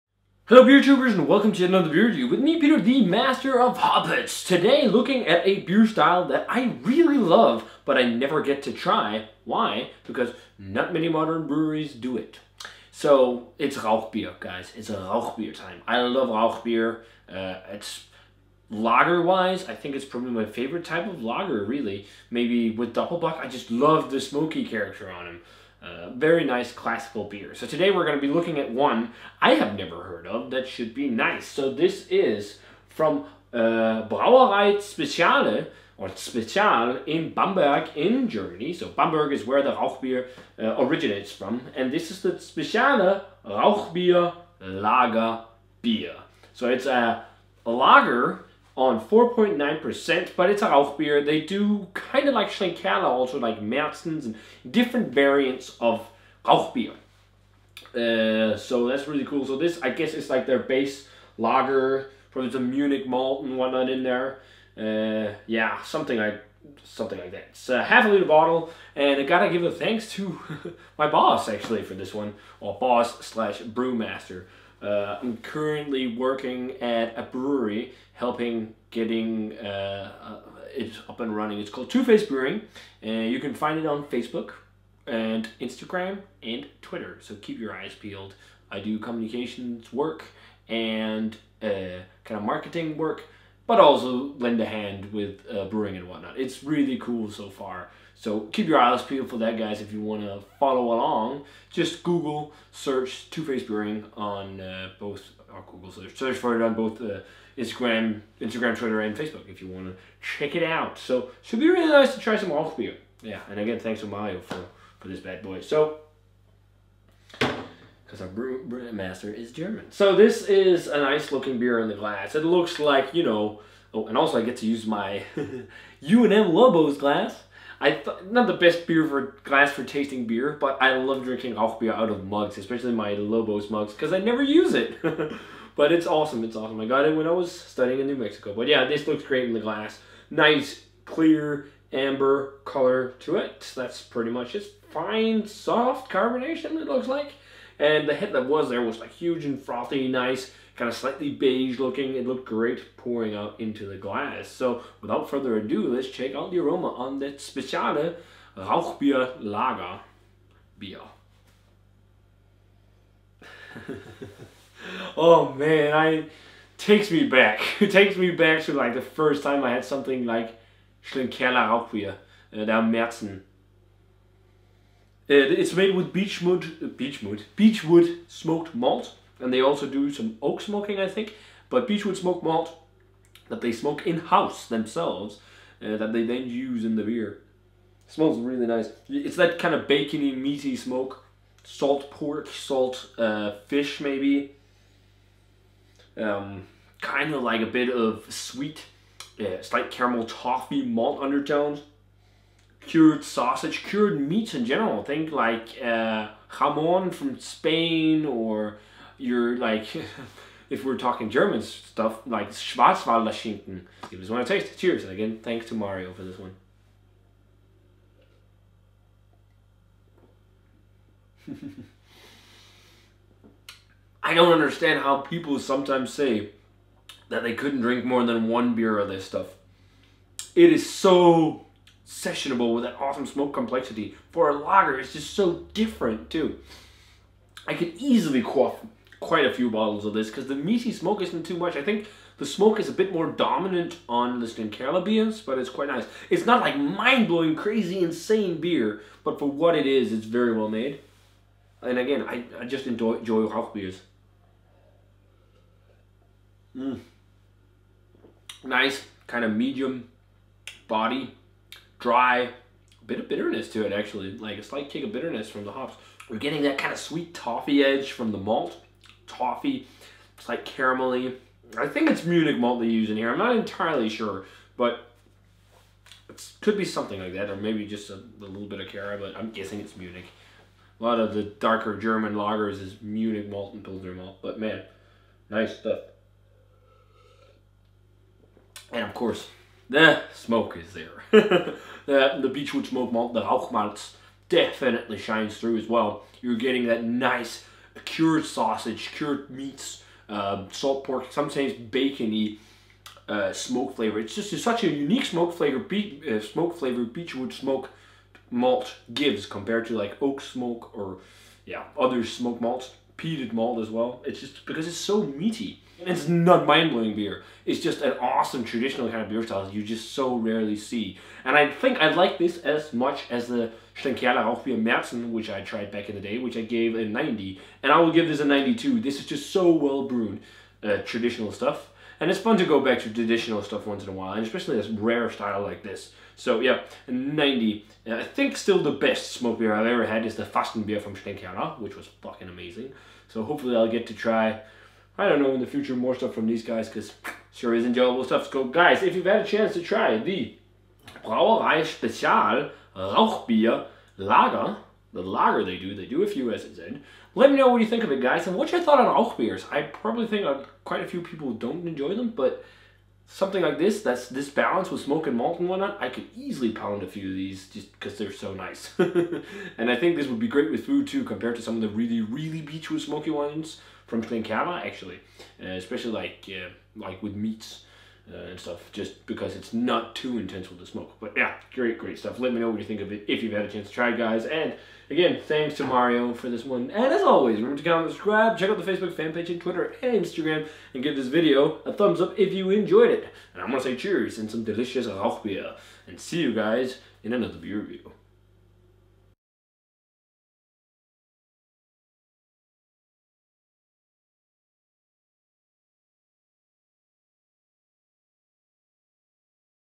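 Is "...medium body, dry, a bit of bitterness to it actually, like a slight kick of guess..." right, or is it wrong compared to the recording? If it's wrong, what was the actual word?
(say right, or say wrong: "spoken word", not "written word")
wrong: "bitterness", not "guess".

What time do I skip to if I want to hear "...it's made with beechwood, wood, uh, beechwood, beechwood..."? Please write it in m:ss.
2:55.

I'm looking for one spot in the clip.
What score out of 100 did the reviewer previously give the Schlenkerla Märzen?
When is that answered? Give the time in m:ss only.
5:26.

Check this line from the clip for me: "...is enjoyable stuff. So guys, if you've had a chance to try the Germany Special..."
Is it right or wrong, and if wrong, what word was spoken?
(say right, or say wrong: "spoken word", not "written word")
wrong: "Brauerei", not "Germany".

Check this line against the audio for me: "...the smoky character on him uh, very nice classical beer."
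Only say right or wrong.
right.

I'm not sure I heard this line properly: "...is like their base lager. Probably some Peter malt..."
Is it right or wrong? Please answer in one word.
wrong.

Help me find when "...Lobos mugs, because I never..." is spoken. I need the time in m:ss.
2:13.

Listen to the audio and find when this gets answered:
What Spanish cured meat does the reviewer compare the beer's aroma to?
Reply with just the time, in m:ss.
3:26.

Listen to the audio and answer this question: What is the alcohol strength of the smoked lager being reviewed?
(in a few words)
4.9%.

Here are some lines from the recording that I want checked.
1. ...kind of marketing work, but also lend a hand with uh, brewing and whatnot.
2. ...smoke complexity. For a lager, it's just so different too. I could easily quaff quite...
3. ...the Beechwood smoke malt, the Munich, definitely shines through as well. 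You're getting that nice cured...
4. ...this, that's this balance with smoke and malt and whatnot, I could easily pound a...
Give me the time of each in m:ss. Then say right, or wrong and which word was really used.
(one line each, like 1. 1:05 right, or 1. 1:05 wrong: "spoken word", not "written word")
1. 1:32 right
2. 3:53 right
3. 4:52 wrong: "Rauchmalz", not "Munich"
4. 6:03 right.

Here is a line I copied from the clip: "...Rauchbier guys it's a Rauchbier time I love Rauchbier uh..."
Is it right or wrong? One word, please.
right.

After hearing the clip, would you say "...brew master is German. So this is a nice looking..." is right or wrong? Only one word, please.
right.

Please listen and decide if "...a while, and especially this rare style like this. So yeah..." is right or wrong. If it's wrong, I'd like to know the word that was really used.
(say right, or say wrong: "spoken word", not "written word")
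right.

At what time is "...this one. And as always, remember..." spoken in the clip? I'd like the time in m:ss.
6:26.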